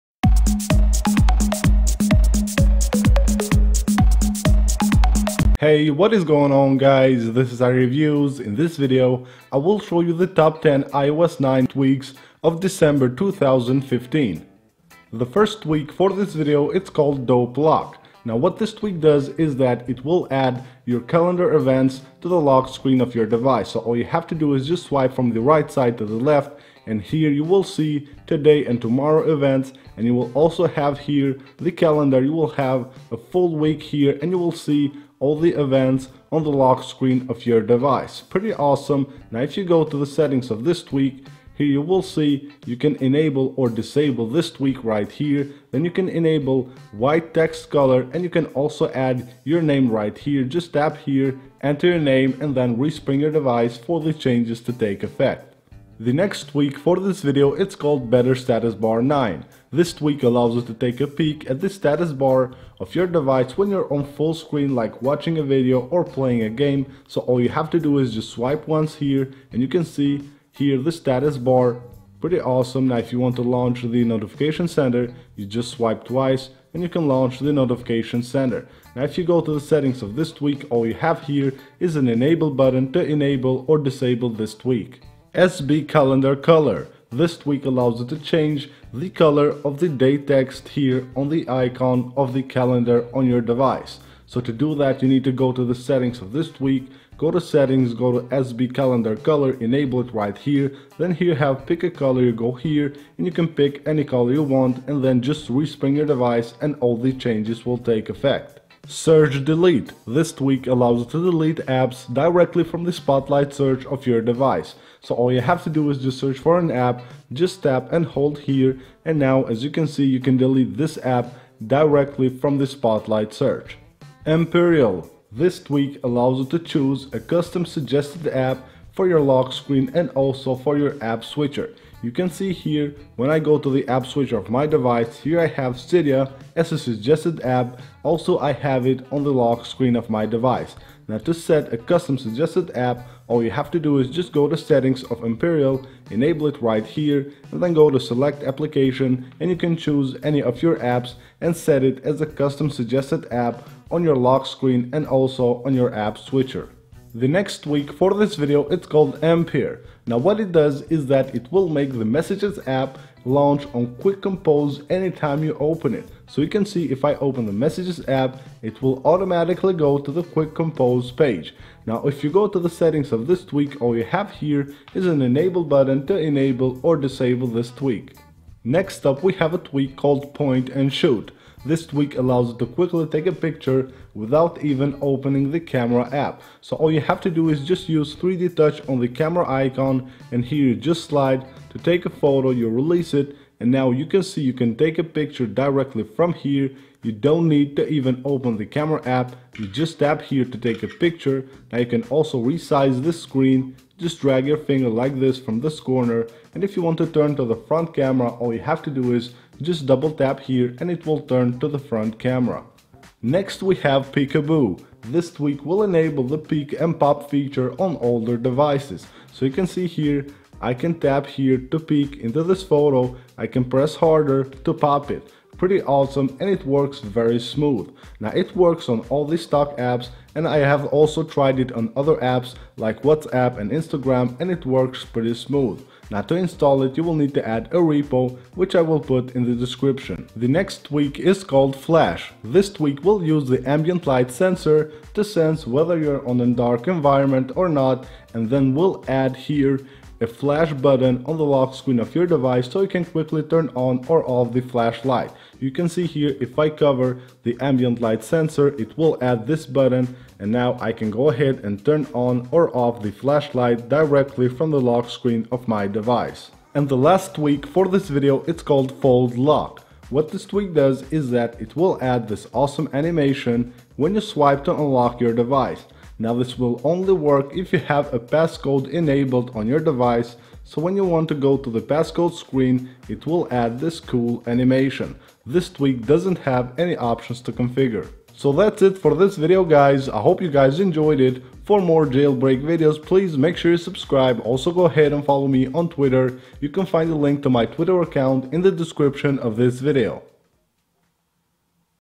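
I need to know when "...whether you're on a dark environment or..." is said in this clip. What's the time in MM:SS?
04:05.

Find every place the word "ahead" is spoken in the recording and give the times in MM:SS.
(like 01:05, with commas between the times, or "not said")
04:21, 04:54.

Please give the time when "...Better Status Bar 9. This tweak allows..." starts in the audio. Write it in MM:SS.
00:58.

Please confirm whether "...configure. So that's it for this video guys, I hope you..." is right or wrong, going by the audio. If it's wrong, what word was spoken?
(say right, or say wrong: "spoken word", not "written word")
right.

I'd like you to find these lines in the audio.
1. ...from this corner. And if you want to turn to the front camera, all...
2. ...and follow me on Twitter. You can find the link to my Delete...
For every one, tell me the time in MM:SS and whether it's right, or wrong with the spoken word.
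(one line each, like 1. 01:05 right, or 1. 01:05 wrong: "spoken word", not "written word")
1. 03:25 right
2. 04:55 wrong: "Twitter", not "Delete".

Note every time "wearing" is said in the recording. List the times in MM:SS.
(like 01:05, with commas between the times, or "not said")
not said.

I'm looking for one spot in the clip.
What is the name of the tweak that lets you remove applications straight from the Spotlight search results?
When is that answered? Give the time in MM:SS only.
01:48.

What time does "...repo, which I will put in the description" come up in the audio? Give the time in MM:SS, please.
03:57.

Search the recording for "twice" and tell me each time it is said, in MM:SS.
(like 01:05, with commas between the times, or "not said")
01:16.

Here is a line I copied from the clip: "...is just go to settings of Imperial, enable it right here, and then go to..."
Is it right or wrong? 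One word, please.
right.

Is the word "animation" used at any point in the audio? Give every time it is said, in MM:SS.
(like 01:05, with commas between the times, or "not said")
04:32, 04:44.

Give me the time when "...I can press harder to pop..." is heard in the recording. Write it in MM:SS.
03:43.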